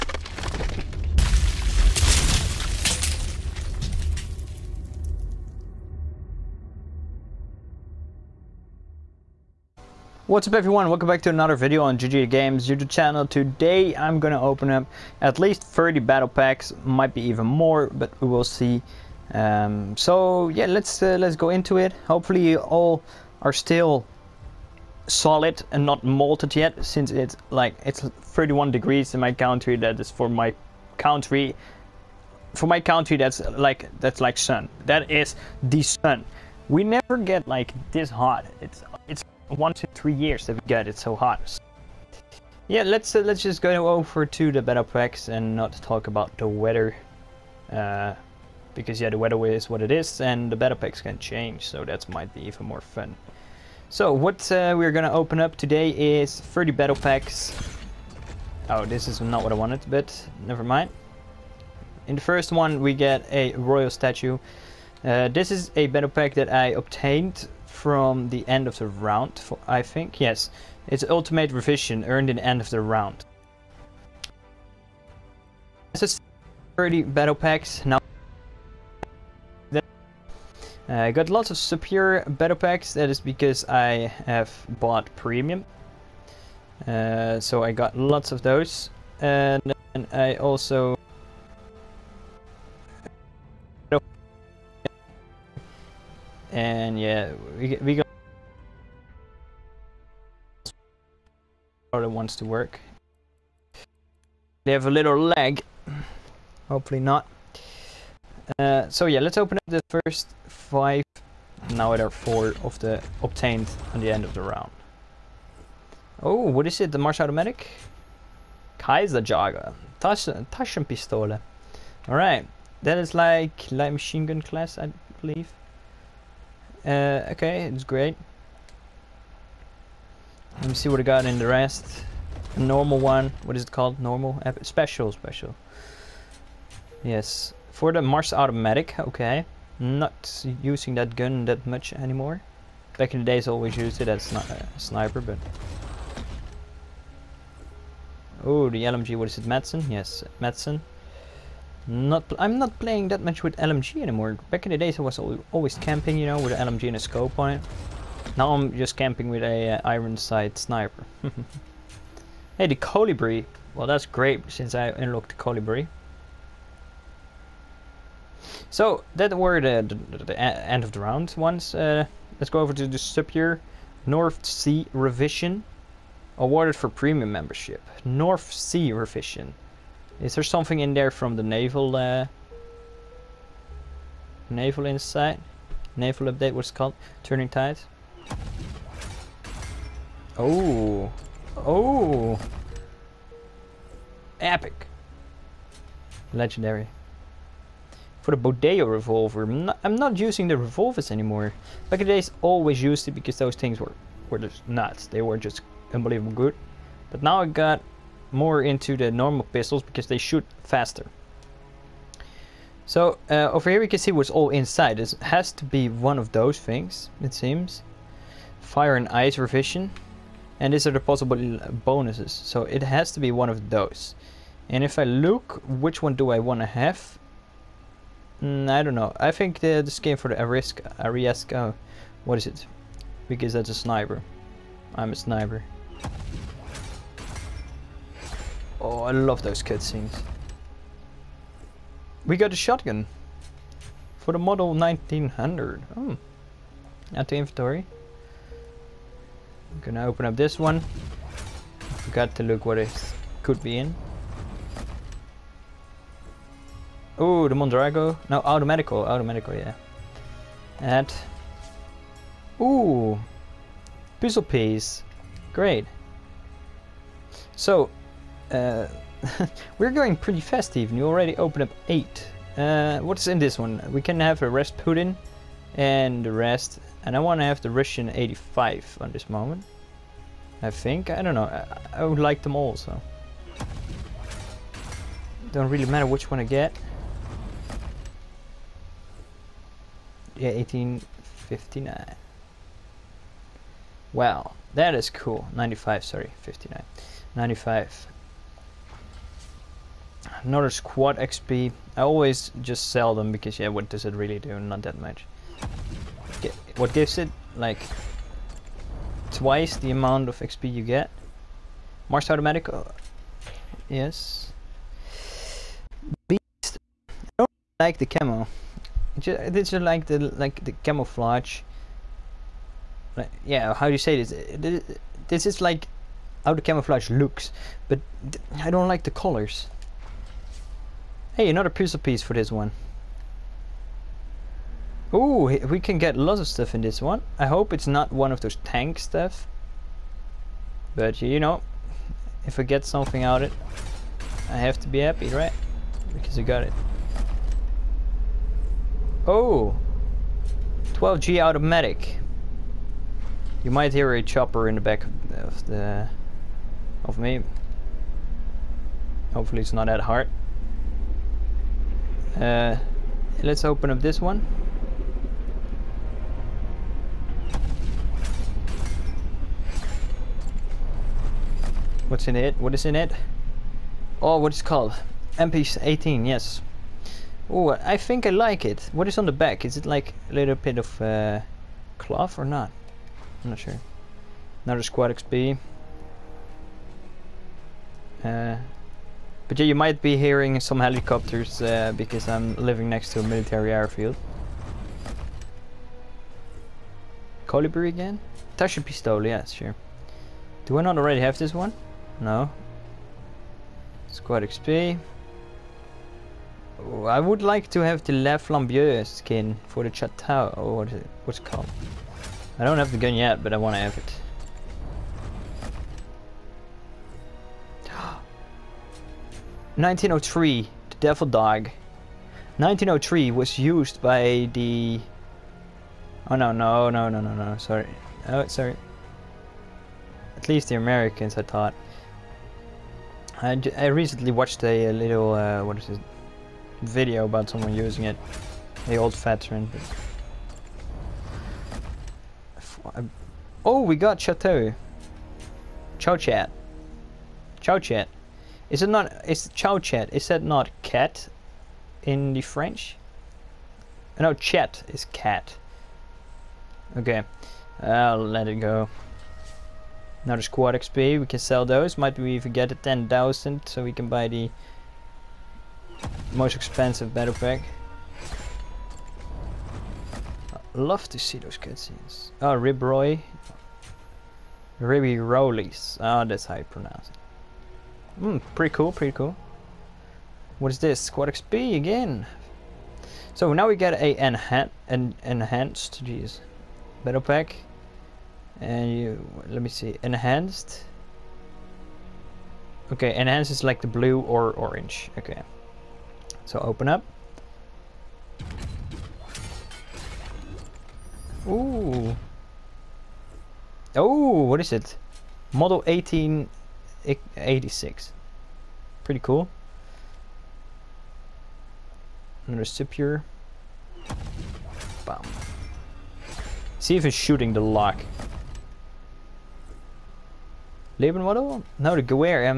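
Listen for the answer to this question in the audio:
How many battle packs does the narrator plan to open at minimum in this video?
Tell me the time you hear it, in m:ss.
0:15.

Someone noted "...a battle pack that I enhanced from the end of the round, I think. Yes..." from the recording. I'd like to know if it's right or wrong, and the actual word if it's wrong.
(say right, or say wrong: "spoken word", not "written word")
wrong: "obtained", not "enhanced".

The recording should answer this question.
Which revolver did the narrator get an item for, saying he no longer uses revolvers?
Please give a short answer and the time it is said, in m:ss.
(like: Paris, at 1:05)
Bodeo, at 3:18.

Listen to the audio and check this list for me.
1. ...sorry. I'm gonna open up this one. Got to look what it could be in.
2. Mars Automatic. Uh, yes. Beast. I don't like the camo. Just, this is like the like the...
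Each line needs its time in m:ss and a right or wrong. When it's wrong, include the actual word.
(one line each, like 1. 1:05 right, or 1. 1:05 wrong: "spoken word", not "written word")
1. 4:07 wrong: "inventory", not "sorry"
2. 5:12 right.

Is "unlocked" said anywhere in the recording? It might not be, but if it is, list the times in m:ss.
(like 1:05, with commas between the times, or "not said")
2:44.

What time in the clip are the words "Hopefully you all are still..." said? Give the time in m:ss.
0:22.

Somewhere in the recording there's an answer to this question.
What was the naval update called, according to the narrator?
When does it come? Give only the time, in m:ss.
3:07.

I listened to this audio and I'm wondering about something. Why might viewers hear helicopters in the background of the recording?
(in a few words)
military airfield.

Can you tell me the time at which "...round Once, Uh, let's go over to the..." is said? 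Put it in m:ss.
2:50.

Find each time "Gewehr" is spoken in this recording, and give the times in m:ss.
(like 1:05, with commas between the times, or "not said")
8:42.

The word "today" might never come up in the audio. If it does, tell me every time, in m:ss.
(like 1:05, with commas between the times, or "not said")
0:13, 0:55.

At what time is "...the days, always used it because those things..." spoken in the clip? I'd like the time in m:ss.
3:22.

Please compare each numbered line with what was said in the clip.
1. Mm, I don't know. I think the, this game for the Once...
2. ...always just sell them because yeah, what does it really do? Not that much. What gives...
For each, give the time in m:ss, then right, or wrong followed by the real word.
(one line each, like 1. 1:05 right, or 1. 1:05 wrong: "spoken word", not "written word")
1. 3:48 wrong: "Arisk", not "Once"
2. 5:02 right.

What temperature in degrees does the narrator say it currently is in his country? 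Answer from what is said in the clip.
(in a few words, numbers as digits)
31.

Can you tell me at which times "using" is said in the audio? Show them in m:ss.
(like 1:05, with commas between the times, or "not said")
2:20, 3:20, 7:17.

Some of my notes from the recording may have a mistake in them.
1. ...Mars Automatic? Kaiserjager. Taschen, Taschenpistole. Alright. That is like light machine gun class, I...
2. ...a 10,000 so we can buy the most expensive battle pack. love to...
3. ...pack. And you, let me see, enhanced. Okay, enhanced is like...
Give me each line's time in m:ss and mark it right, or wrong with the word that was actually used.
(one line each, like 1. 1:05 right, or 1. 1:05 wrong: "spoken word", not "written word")
1. 1:56 right
2. 7:42 right
3. 8:07 right.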